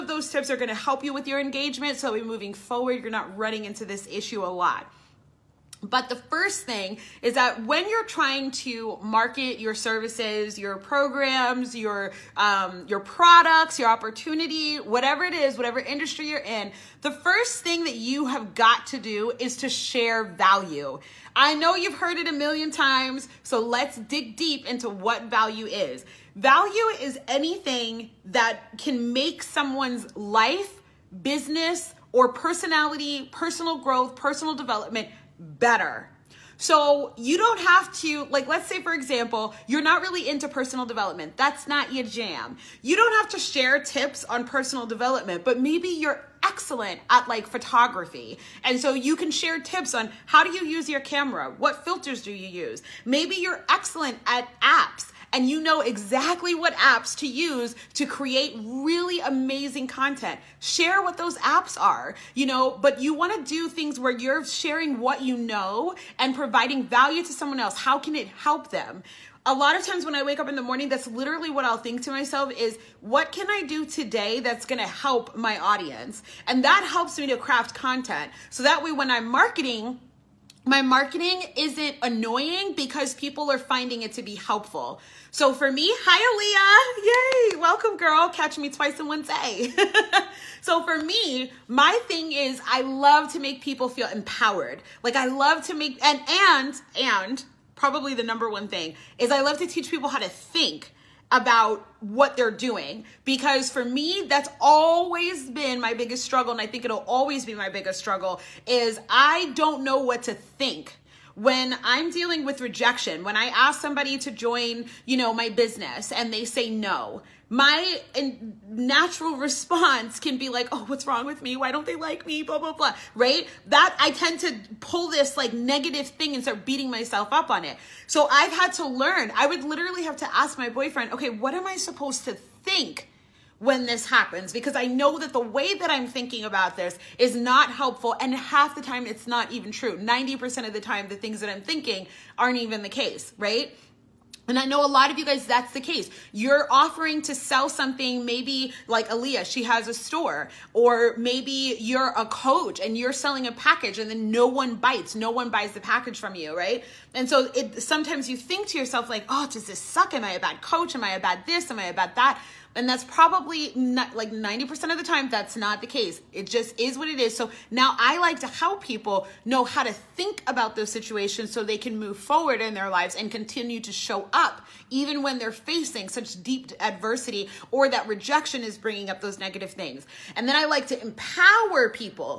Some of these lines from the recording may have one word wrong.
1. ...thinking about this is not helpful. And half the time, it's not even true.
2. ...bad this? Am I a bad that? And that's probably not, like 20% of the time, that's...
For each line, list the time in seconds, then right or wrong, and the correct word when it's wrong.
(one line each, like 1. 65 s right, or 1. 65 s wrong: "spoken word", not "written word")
1. 136 s right
2. 161 s wrong: "90", not "20".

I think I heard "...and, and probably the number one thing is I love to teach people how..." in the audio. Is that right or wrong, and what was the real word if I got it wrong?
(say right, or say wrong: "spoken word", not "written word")
right.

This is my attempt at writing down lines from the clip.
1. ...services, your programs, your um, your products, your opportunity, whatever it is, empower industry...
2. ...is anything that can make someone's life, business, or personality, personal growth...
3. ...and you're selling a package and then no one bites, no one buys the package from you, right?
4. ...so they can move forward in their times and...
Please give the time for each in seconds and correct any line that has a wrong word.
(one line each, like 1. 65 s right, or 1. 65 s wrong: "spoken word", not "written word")
1. 9 s wrong: "whatever", not "empower"
2. 27 s right
3. 152 s right
4. 171 s wrong: "lives", not "times".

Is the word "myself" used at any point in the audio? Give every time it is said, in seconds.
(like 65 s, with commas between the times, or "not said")
72 s, 126 s.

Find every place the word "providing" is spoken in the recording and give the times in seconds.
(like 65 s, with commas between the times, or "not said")
66 s.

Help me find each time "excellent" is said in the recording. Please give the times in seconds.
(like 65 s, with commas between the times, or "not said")
46 s, 53 s.